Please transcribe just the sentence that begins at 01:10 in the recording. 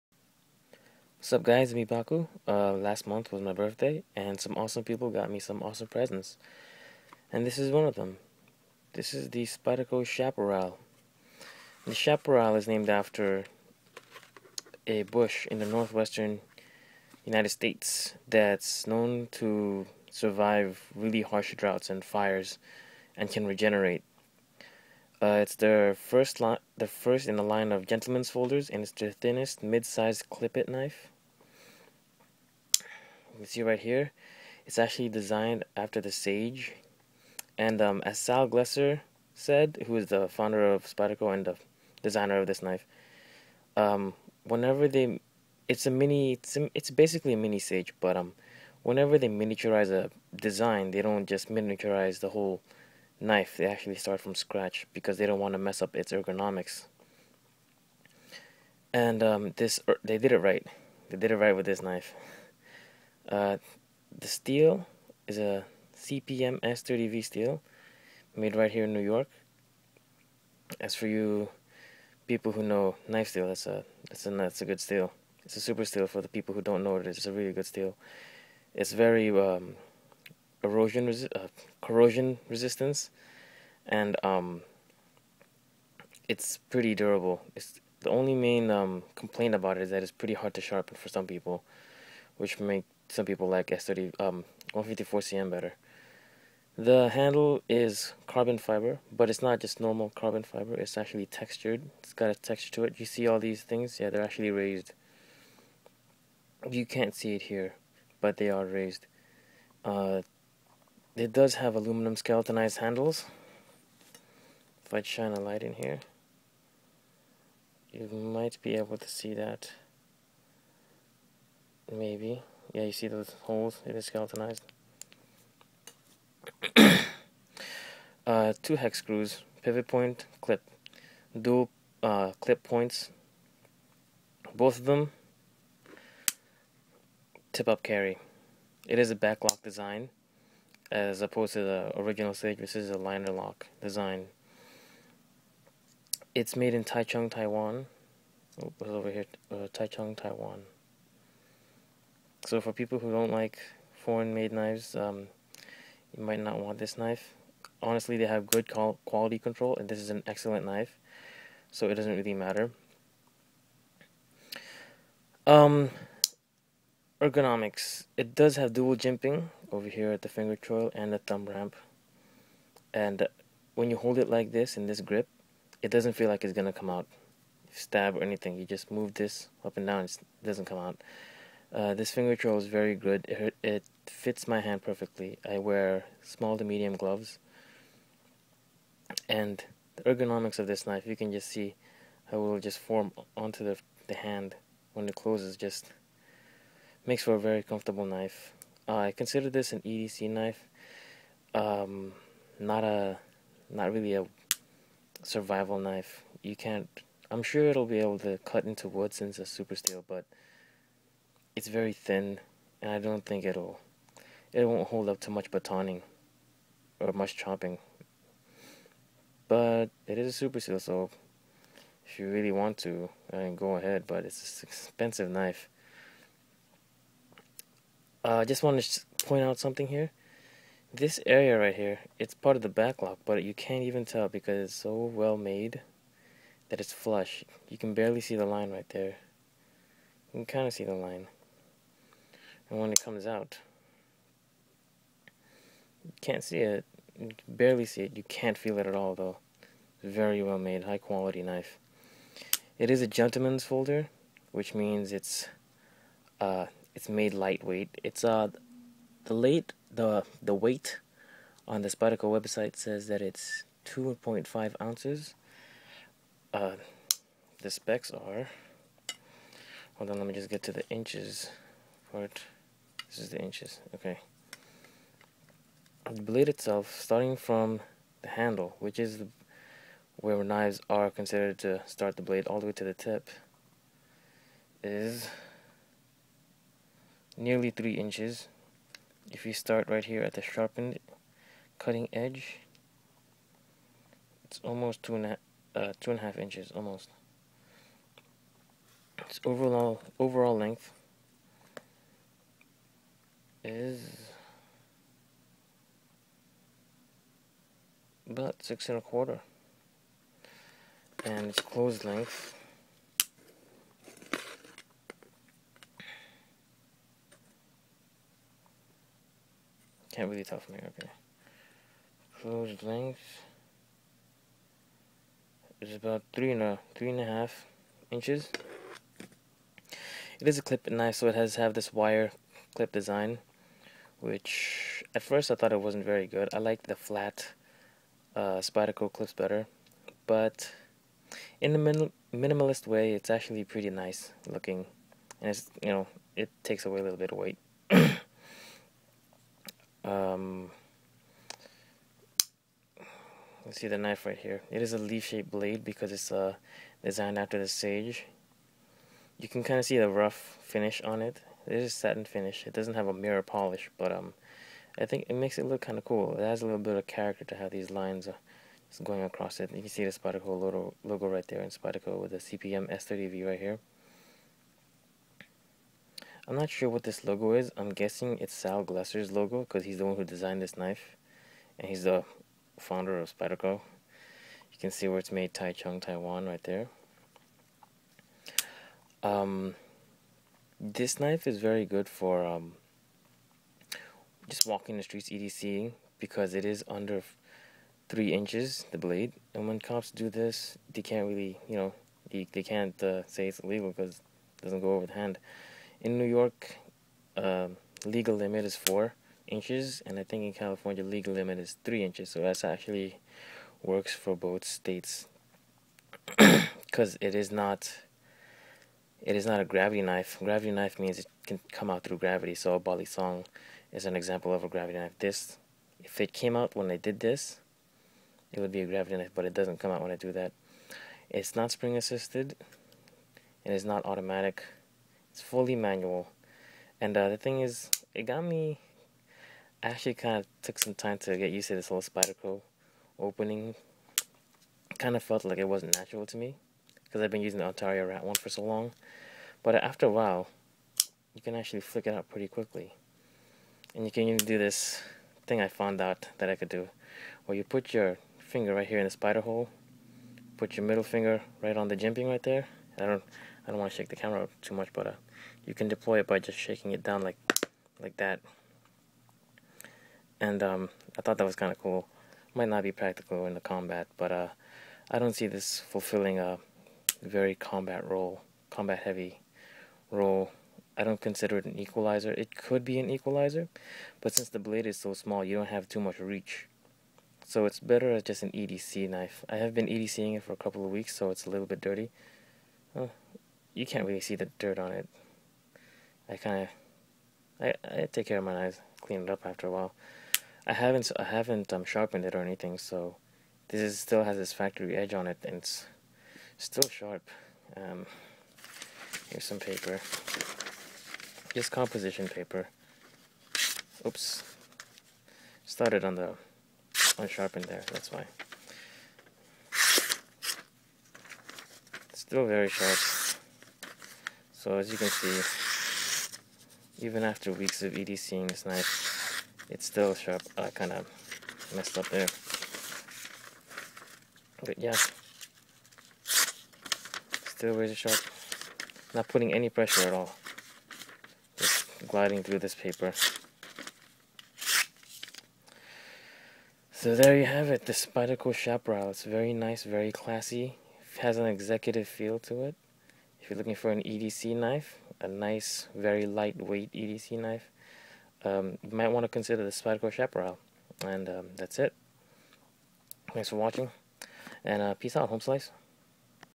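As for you people who know knife steel, that's a that's a that's a good steel.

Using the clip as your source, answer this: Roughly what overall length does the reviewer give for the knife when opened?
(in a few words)
6 and a quarter inches.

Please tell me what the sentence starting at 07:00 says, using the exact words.
Gravity knife means it can come out through gravity.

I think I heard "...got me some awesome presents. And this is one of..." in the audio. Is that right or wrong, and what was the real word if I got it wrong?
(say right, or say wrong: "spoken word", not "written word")
right.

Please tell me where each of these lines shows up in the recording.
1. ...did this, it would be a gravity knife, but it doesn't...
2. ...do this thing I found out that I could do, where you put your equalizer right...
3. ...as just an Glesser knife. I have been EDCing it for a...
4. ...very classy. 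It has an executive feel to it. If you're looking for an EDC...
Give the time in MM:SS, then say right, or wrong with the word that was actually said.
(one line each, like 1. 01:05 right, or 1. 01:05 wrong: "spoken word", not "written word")
1. 07:06 right
2. 07:34 wrong: "finger", not "equalizer"
3. 08:08 wrong: "EDC", not "Glesser"
4. 09:09 right.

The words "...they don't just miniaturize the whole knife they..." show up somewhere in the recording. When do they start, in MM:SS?
00:50.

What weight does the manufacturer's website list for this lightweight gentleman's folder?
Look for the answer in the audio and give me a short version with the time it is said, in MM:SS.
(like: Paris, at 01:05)
2.5 ounces, at 04:23.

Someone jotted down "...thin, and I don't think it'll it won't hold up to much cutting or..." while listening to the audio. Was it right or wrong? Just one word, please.
wrong.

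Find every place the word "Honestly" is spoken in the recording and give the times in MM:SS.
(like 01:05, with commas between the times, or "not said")
02:37.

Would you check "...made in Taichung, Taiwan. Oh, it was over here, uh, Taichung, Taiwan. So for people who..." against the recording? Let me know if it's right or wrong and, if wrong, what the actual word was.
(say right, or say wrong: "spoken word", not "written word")
right.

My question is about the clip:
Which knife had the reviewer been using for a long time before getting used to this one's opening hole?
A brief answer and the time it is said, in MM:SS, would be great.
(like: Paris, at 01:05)
Ontario Rat one, at 07:27.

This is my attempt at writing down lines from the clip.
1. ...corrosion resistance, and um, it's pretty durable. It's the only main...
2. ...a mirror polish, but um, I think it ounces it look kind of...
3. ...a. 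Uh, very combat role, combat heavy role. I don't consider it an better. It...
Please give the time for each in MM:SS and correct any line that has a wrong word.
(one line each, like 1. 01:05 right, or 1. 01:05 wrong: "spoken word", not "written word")
1. 01:21 right
2. 06:03 wrong: "makes", not "ounces"
3. 07:56 wrong: "equalizer", not "better".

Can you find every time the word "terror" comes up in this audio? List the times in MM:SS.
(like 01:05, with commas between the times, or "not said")
not said.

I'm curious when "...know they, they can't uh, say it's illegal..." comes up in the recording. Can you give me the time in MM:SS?
06:41.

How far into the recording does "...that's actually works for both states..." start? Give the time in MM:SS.
06:52.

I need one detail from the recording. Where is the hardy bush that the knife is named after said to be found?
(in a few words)
Northwestern United States.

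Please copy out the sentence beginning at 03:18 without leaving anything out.
Uh, I consider this an EDC knife.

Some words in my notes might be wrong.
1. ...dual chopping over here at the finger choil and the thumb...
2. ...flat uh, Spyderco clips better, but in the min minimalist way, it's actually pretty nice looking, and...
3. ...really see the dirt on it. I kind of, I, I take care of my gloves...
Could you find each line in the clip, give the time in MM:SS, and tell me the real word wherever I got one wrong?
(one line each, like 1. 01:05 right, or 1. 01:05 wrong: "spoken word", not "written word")
1. 02:48 wrong: "jimping", not "chopping"
2. 05:36 right
3. 08:14 wrong: "knives", not "gloves".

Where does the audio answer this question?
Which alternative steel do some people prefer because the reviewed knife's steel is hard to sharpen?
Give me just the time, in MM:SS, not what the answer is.
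01:34.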